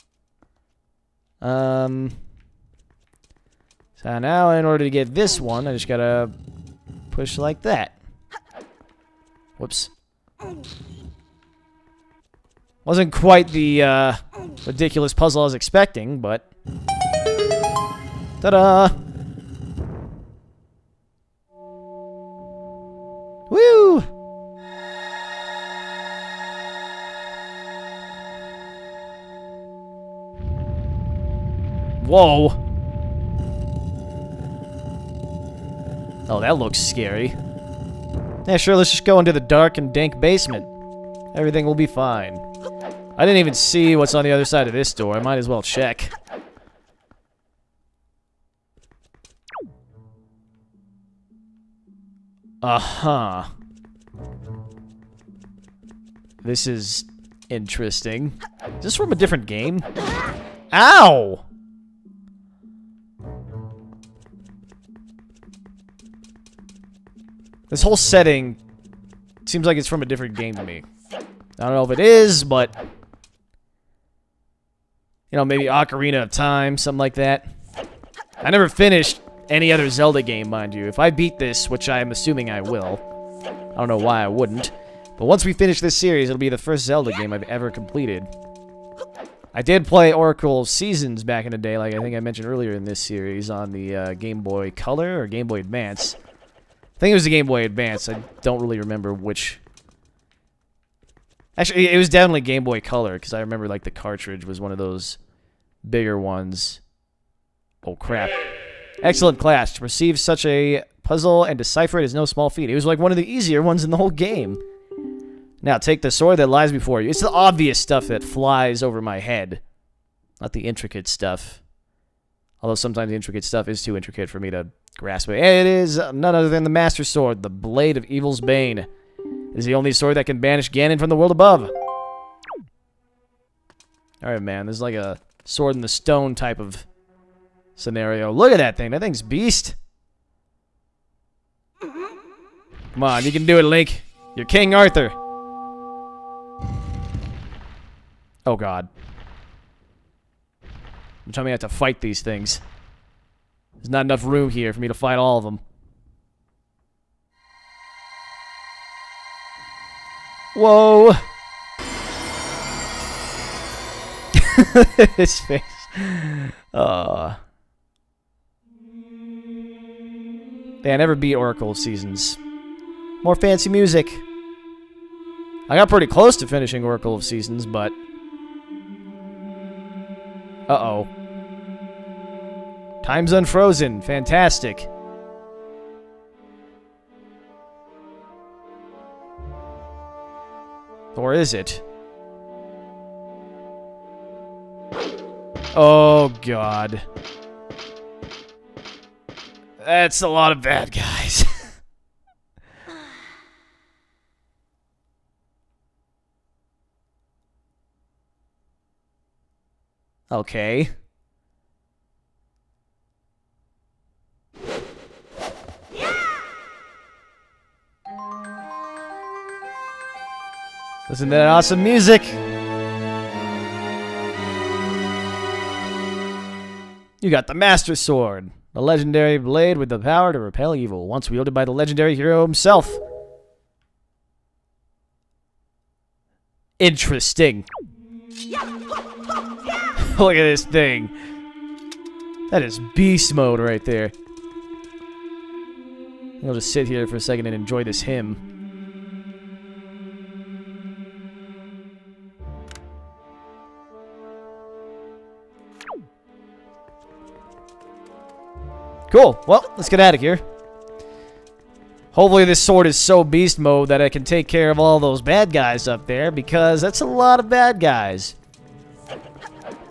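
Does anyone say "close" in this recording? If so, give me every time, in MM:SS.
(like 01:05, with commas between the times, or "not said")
02:56.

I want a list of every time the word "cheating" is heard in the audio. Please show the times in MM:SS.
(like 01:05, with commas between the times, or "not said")
not said.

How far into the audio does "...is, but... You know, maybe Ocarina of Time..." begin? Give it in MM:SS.
01:12.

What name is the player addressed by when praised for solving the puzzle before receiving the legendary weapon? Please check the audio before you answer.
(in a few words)
Clash.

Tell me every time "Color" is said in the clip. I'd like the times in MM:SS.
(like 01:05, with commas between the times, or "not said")
01:34, 01:42.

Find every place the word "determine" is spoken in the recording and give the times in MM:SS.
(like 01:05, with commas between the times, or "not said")
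not said.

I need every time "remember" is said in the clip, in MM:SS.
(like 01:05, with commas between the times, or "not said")
01:38, 01:43.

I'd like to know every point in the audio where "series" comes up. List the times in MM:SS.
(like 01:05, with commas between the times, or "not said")
01:25, 01:33.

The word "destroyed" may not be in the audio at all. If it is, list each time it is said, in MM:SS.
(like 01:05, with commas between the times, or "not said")
not said.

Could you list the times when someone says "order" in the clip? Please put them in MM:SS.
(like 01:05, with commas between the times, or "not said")
00:04.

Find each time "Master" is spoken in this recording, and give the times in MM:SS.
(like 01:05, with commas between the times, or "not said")
02:06, 03:47.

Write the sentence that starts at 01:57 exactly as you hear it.
It's the obvious stuff that flies over my head, not the intricate stuff.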